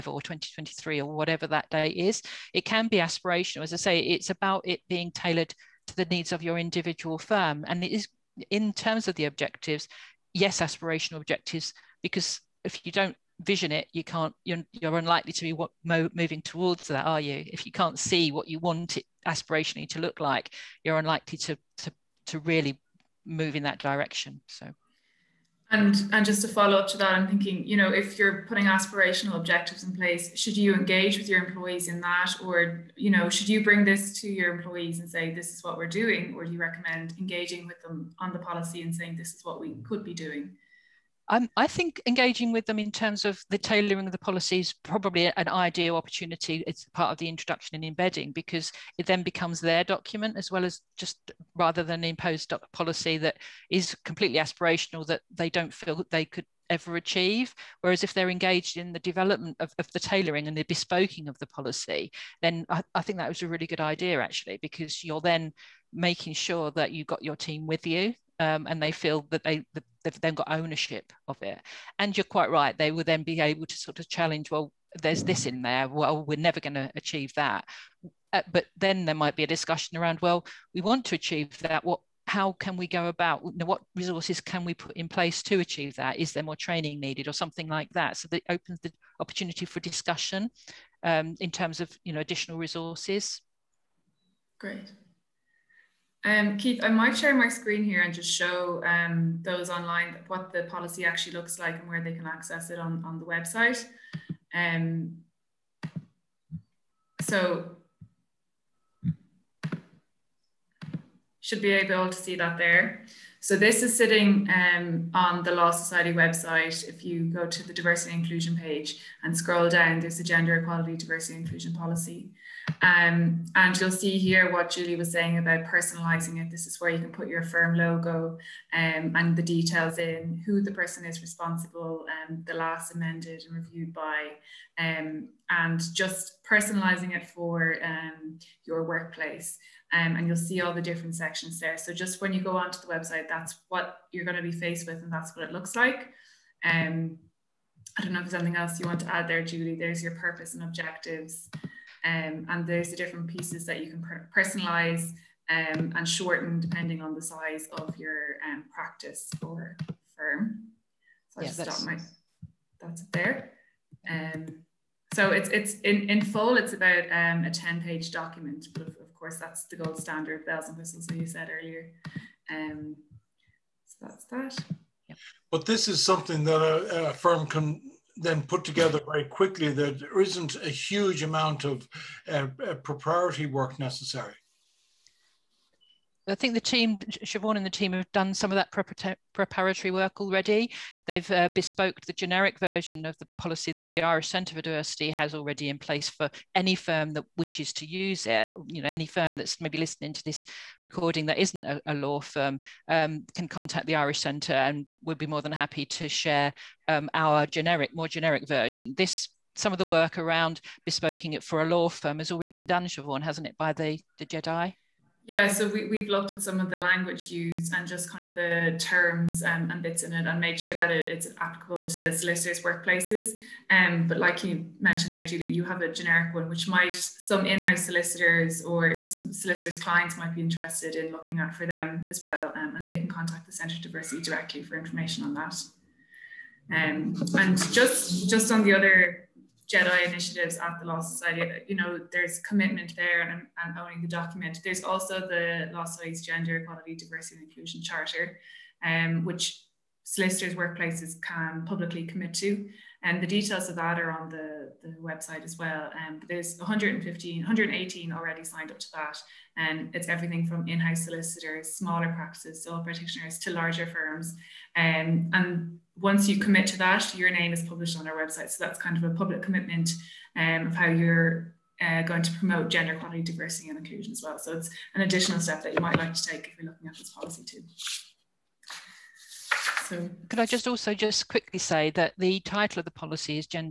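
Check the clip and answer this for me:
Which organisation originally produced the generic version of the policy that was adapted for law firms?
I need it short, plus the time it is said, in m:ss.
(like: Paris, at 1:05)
Irish Centre for Diversity, at 3:14.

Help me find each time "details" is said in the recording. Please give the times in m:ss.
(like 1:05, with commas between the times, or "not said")
2:09, 4:13.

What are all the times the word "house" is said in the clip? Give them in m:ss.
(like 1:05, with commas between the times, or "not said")
3:47, 4:20.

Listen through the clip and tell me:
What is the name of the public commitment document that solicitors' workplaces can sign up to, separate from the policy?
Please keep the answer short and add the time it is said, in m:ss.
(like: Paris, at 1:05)
Gender Equality, Diversity and Inclusion Charter, at 4:06.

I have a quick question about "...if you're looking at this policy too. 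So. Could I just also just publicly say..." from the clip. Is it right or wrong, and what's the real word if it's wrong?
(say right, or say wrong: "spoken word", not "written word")
wrong: "quickly", not "publicly".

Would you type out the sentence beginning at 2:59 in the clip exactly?
There isn't a huge amount of uh, uh proprietary work necessary.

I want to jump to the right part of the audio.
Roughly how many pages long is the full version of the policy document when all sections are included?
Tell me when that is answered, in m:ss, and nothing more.
2:47.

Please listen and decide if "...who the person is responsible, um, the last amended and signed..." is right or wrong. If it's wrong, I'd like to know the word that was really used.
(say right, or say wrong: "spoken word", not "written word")
wrong: "reviewed", not "signed".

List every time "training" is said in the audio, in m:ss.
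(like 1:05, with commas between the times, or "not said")
1:26.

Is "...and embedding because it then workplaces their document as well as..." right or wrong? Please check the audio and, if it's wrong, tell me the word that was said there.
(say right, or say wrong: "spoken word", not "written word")
wrong: "becomes", not "workplaces".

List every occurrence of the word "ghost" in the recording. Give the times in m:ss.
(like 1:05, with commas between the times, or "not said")
not said.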